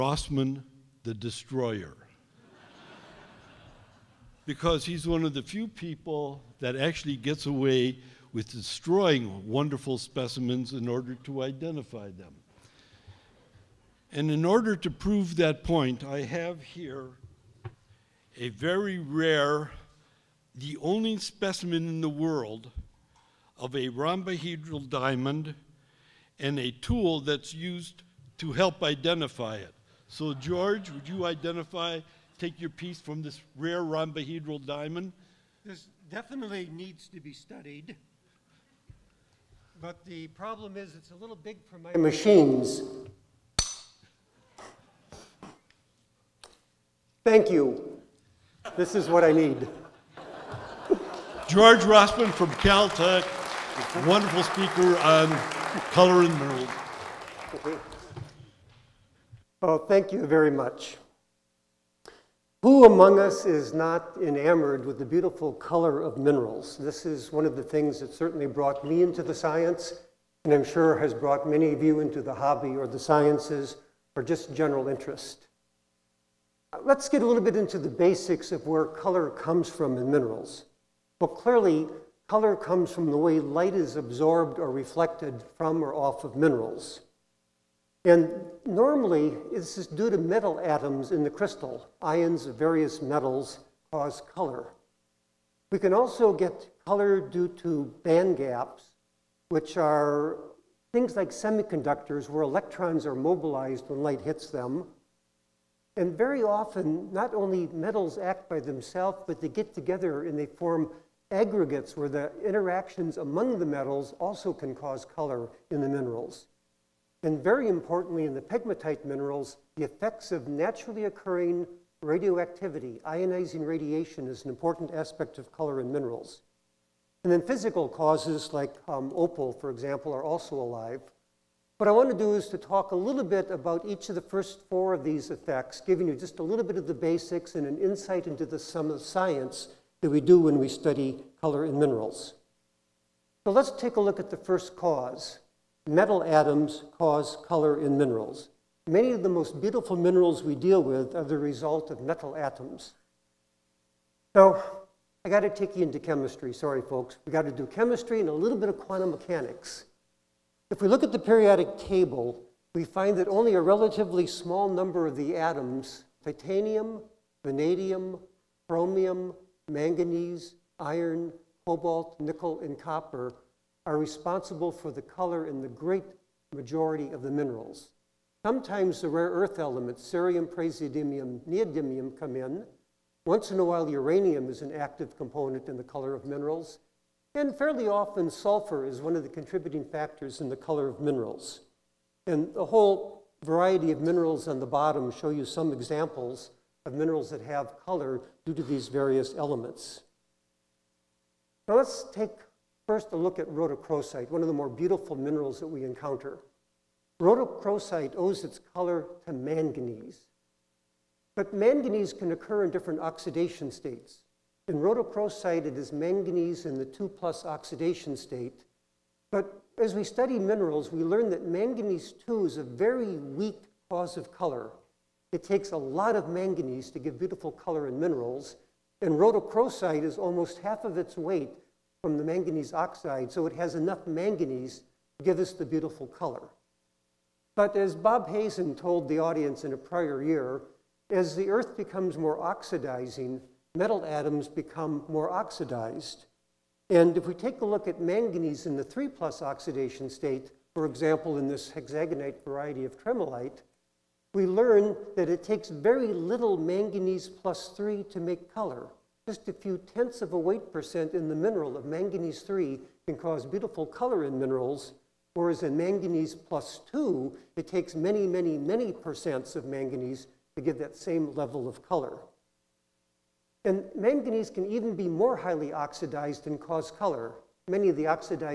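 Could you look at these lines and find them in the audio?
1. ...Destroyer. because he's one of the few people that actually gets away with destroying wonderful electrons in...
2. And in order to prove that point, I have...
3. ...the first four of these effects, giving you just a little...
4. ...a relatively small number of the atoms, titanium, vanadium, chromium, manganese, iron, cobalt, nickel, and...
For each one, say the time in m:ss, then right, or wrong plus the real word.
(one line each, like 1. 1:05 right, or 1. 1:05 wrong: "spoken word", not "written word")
1. 0:01 wrong: "specimens", not "electrons"
2. 0:14 right
3. 2:14 right
4. 2:43 right.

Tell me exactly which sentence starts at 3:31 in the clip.
But manganese can occur in different oxidation states.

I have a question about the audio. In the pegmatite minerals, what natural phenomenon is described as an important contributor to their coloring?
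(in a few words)
naturally occurring radioactivity.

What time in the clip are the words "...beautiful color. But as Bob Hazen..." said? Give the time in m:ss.
3:55.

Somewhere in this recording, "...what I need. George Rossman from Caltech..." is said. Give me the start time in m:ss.
0:49.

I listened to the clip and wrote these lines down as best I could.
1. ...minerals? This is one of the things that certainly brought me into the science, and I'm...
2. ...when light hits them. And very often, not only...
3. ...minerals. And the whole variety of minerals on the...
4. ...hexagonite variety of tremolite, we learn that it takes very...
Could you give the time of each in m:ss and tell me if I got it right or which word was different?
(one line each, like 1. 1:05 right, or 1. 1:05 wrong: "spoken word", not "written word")
1. 1:06 right
2. 1:43 right
3. 3:11 right
4. 4:11 right.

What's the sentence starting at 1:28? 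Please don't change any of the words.
And normally, this is due to metal atoms in the crystal.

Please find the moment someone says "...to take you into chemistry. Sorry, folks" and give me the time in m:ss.
2:35.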